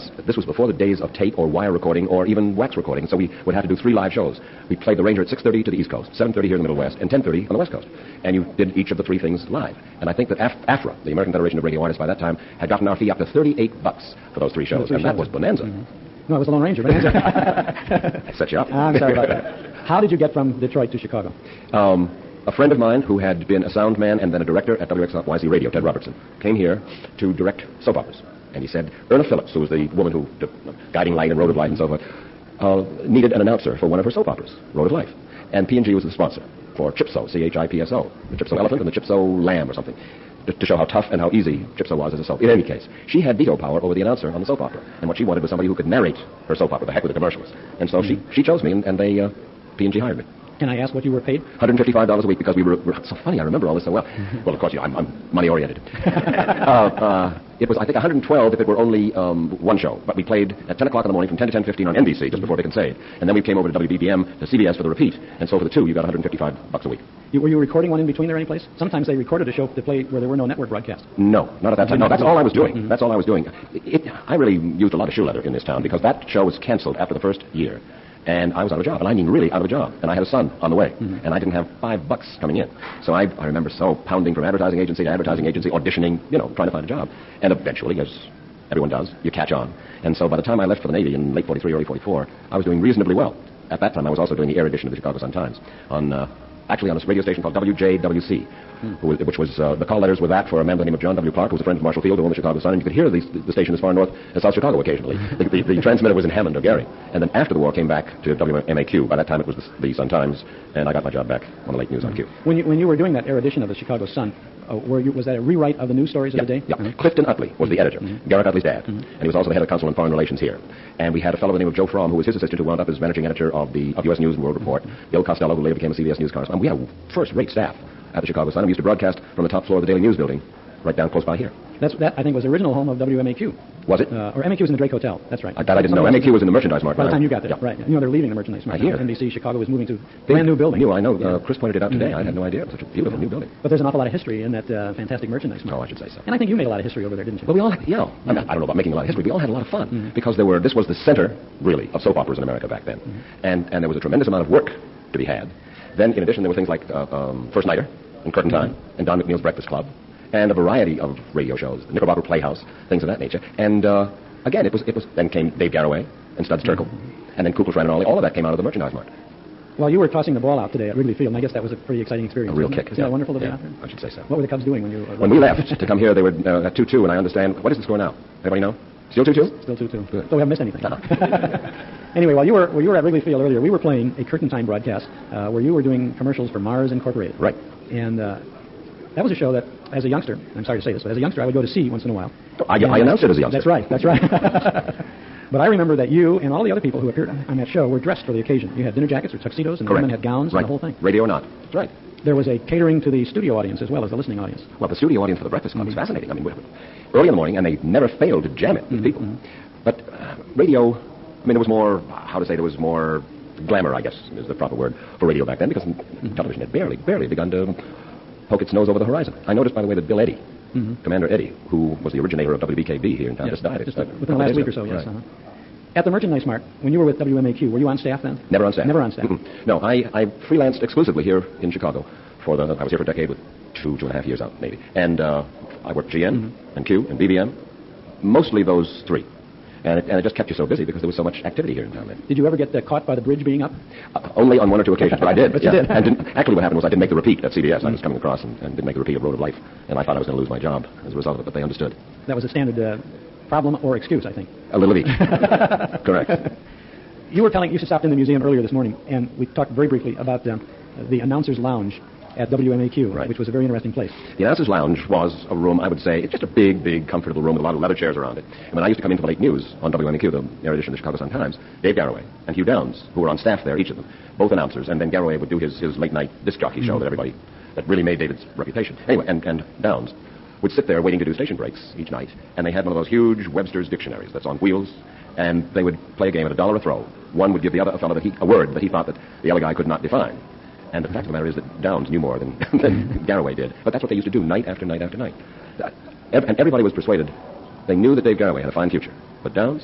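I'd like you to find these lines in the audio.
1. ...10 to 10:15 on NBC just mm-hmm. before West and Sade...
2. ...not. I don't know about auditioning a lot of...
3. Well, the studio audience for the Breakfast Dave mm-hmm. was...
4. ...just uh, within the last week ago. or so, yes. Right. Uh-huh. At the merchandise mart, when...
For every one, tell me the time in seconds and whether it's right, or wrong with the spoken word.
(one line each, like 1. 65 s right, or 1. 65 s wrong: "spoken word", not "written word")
1. 61 s wrong: "Vic", not "West"
2. 148 s wrong: "making", not "auditioning"
3. 204 s wrong: "Club", not "Dave"
4. 223 s right.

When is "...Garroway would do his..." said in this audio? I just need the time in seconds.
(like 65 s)
275 s.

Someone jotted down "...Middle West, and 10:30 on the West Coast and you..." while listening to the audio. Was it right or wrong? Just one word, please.
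right.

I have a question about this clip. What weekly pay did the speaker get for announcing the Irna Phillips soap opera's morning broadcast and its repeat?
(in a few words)
$155.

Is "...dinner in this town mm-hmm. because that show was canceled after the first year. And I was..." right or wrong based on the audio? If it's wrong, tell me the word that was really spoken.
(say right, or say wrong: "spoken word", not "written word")
wrong: "leather", not "dinner".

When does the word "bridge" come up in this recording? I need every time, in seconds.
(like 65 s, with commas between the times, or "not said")
243 s.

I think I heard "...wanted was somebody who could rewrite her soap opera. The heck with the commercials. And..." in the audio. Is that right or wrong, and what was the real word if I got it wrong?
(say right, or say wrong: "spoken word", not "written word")
wrong: "narrate", not "rewrite".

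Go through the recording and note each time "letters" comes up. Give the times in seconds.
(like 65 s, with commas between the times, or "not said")
99 s.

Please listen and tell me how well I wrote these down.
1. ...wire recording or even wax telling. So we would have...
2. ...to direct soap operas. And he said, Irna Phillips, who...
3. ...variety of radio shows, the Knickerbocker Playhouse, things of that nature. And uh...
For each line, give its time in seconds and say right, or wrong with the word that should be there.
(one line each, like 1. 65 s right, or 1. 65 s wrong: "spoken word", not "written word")
1. 1 s wrong: "recording", not "telling"
2. 27 s right
3. 160 s right.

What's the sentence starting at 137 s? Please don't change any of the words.
You know they're leaving the merchandise mart.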